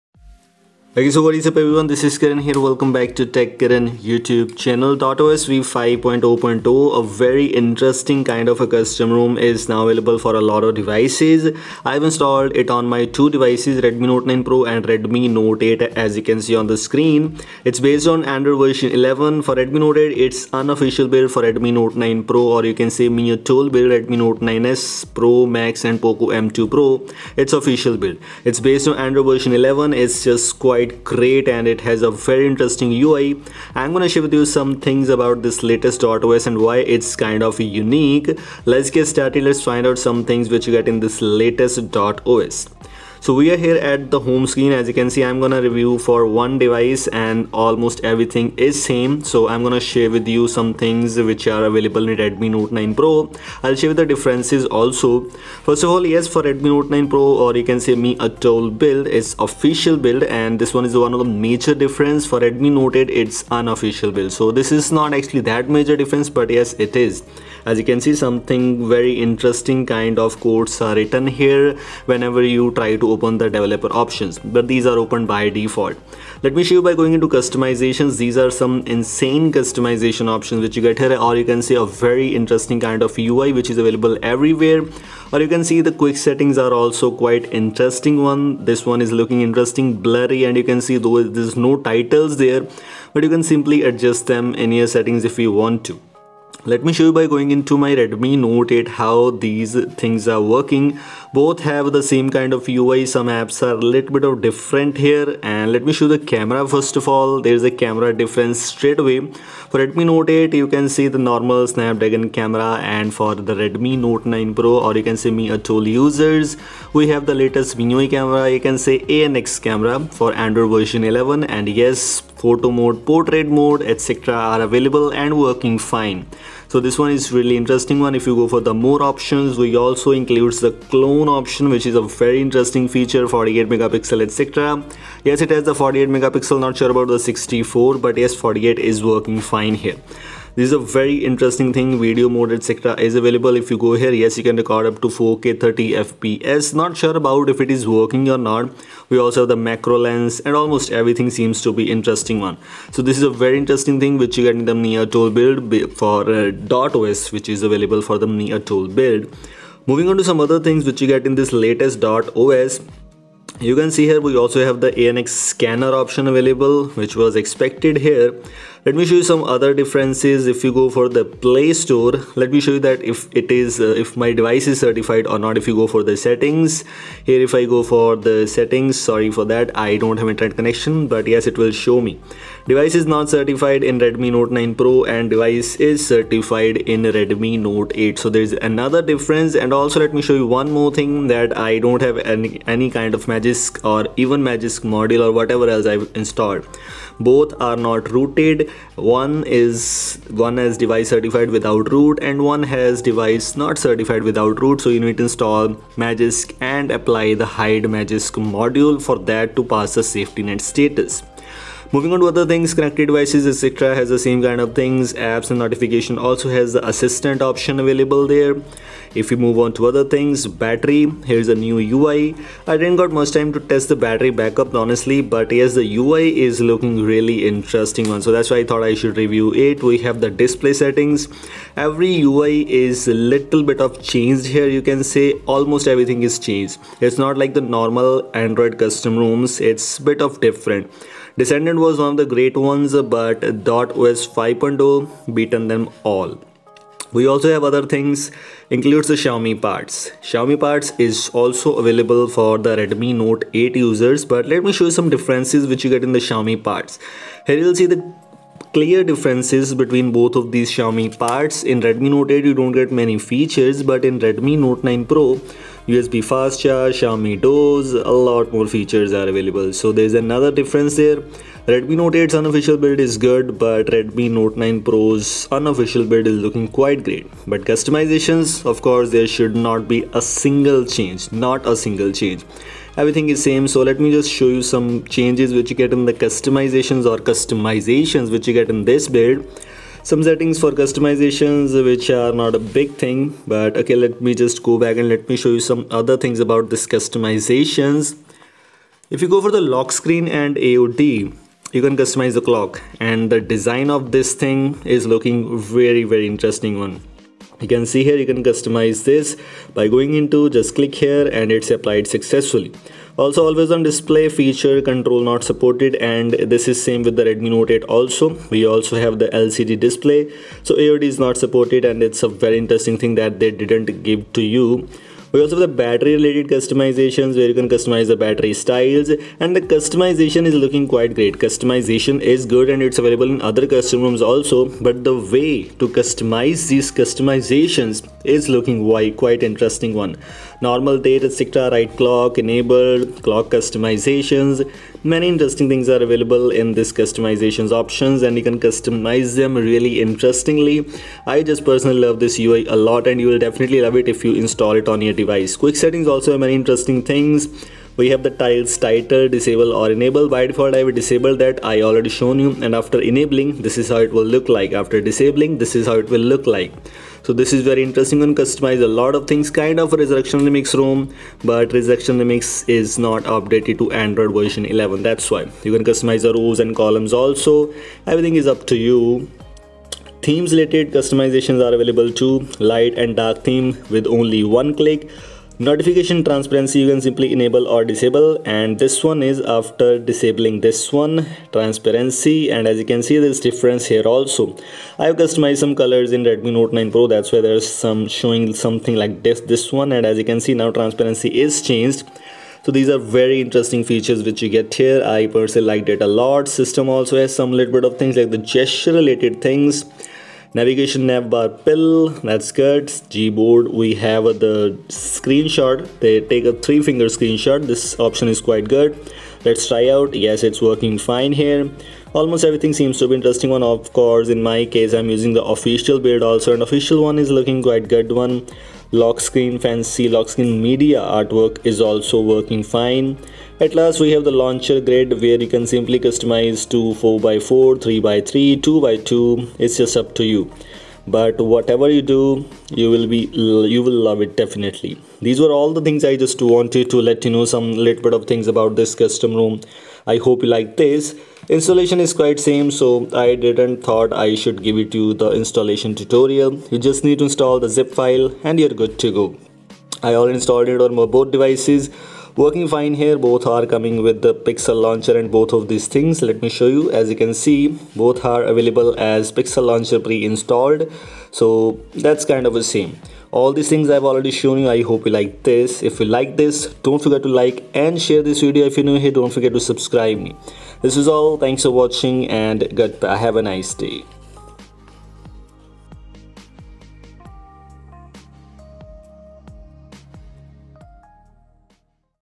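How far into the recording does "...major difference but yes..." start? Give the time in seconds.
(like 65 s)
65 s.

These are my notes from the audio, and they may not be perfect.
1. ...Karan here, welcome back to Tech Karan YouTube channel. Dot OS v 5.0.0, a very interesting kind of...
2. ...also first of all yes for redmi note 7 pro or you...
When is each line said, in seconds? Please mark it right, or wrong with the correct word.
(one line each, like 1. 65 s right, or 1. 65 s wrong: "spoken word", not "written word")
1. 2 s right
2. 54 s wrong: "9", not "7".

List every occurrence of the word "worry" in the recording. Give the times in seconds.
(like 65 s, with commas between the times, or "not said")
not said.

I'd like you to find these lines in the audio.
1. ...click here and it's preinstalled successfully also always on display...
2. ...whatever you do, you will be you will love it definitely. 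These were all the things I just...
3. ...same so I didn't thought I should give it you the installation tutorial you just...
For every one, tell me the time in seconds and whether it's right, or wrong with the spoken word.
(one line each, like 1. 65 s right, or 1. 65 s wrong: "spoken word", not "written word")
1. 310 s wrong: "applied", not "preinstalled"
2. 441 s right
3. 452 s right.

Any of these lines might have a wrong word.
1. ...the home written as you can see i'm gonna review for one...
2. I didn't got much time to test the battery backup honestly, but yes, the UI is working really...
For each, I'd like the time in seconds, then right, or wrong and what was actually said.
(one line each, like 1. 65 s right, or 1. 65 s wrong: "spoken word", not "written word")
1. 44 s wrong: "screen", not "written"
2. 222 s wrong: "looking", not "working".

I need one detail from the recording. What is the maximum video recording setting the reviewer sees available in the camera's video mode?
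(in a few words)
4K 30 fps.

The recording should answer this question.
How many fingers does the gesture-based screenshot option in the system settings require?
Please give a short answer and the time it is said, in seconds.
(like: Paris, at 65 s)
3, at 416 s.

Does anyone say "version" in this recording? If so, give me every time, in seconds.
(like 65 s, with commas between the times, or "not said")
18 s, 29 s, 120 s, 374 s.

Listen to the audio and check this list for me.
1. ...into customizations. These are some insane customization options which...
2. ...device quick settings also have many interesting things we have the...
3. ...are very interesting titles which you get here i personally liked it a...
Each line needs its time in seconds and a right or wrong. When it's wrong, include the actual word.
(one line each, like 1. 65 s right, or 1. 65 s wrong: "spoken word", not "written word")
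1. 77 s right
2. 355 s right
3. 402 s wrong: "features", not "titles".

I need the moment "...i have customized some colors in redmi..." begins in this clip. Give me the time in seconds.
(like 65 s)
394 s.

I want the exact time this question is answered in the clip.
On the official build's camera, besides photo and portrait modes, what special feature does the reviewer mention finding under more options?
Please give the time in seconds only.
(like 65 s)
130 s.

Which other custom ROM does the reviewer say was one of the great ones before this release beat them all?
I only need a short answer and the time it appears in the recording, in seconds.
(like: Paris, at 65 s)
Descendant, at 241 s.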